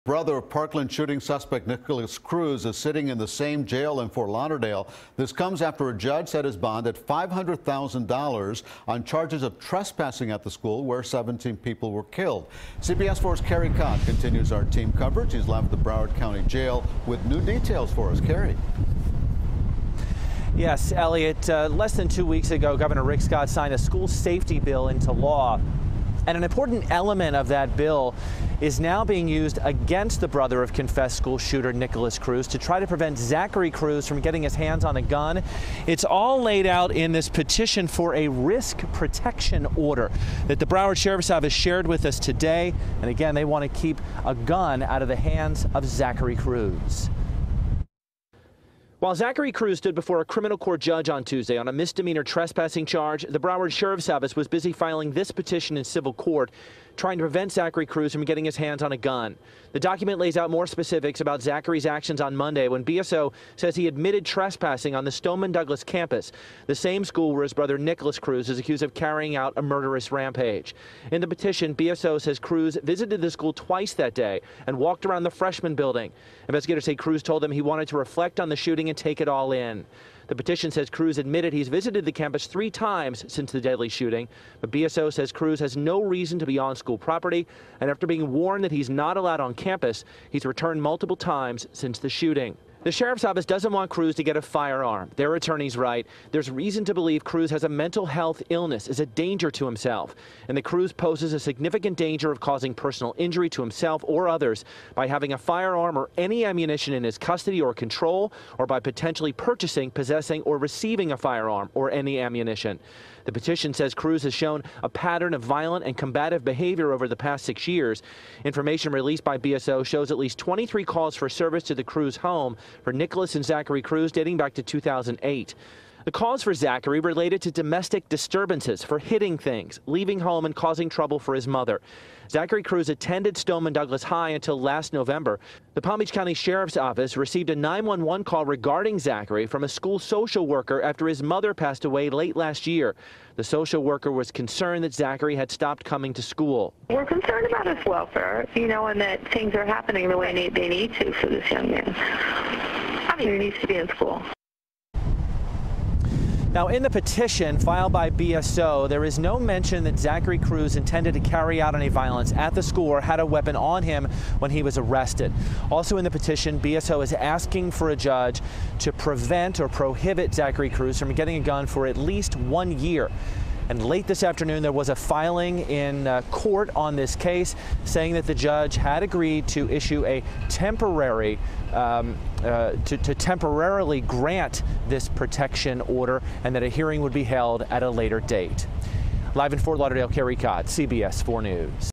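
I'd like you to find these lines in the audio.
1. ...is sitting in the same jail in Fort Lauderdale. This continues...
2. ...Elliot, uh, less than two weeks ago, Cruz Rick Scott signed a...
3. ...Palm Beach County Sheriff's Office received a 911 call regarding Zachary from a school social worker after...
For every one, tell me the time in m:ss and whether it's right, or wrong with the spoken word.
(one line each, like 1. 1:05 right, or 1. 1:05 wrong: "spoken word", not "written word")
1. 0:02 wrong: "comes", not "continues"
2. 0:20 wrong: "Governor", not "Cruz"
3. 2:15 right.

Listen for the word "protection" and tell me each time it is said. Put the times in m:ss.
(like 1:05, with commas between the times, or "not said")
0:38, 3:05.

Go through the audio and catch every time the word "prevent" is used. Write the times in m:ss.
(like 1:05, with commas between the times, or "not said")
0:32, 0:57, 2:48.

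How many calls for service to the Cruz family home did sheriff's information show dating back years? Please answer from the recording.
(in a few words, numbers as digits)
23.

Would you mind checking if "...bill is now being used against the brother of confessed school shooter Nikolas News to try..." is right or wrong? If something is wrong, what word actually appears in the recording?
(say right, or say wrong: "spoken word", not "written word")
wrong: "Cruz", not "News".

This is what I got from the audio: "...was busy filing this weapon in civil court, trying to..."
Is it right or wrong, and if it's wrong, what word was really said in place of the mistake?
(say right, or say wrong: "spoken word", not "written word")
wrong: "petition", not "weapon".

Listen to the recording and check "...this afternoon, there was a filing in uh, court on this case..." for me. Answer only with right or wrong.
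right.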